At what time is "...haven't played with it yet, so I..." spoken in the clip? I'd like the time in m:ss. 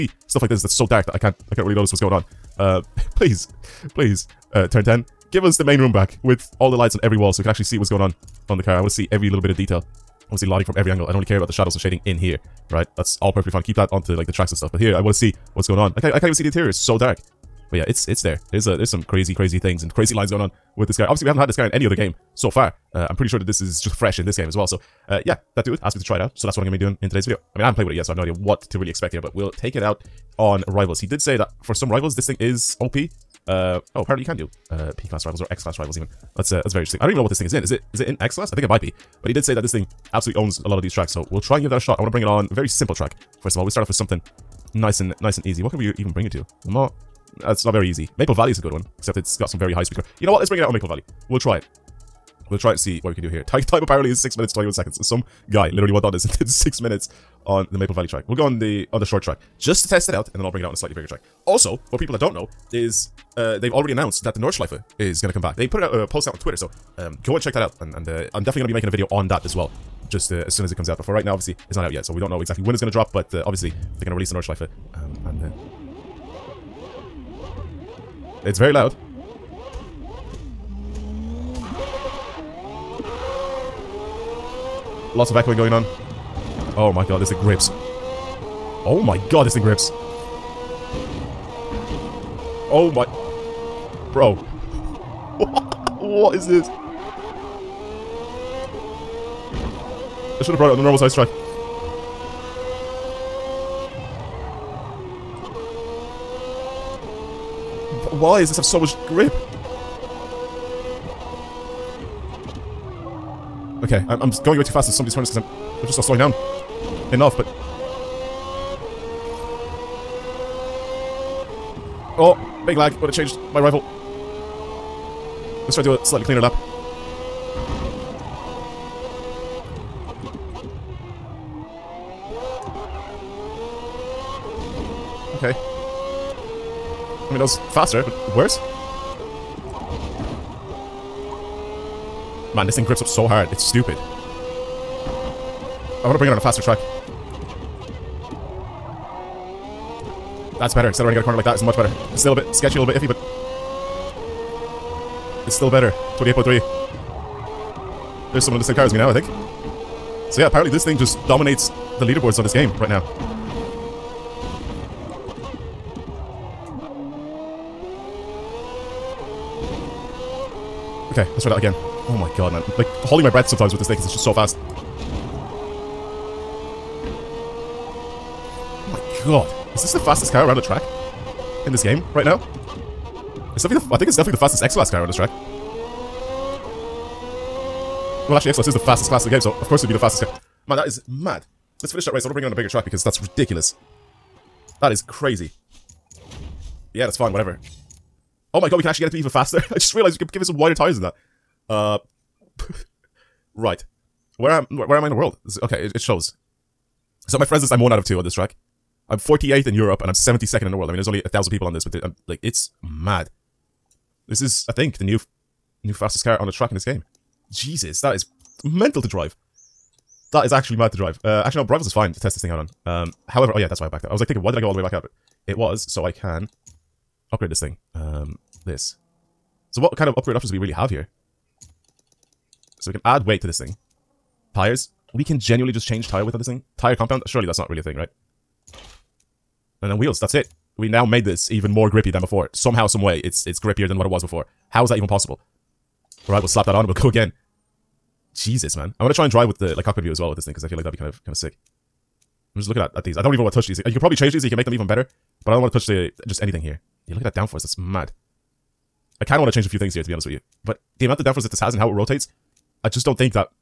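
0:27.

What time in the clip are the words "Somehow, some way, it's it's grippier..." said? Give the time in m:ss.
4:02.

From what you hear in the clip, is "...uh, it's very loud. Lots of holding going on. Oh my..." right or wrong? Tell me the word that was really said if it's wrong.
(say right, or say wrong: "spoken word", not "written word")
wrong: "echoing", not "holding".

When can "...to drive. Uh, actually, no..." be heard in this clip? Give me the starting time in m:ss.
3:40.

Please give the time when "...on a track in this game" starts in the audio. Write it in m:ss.
3:36.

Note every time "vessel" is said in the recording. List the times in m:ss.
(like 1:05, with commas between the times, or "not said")
not said.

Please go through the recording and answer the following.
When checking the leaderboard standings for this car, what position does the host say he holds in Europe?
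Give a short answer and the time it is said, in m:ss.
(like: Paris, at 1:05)
48th, at 3:29.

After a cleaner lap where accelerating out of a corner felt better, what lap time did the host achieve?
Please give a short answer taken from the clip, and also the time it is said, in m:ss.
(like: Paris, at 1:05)
28.3, at 2:36.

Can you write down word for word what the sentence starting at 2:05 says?
Let's try to do a slightly cleaner lap.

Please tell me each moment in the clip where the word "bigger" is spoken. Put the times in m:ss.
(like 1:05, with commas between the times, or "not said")
1:00, 3:12.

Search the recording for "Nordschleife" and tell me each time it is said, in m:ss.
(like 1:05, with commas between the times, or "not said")
1:04, 1:14.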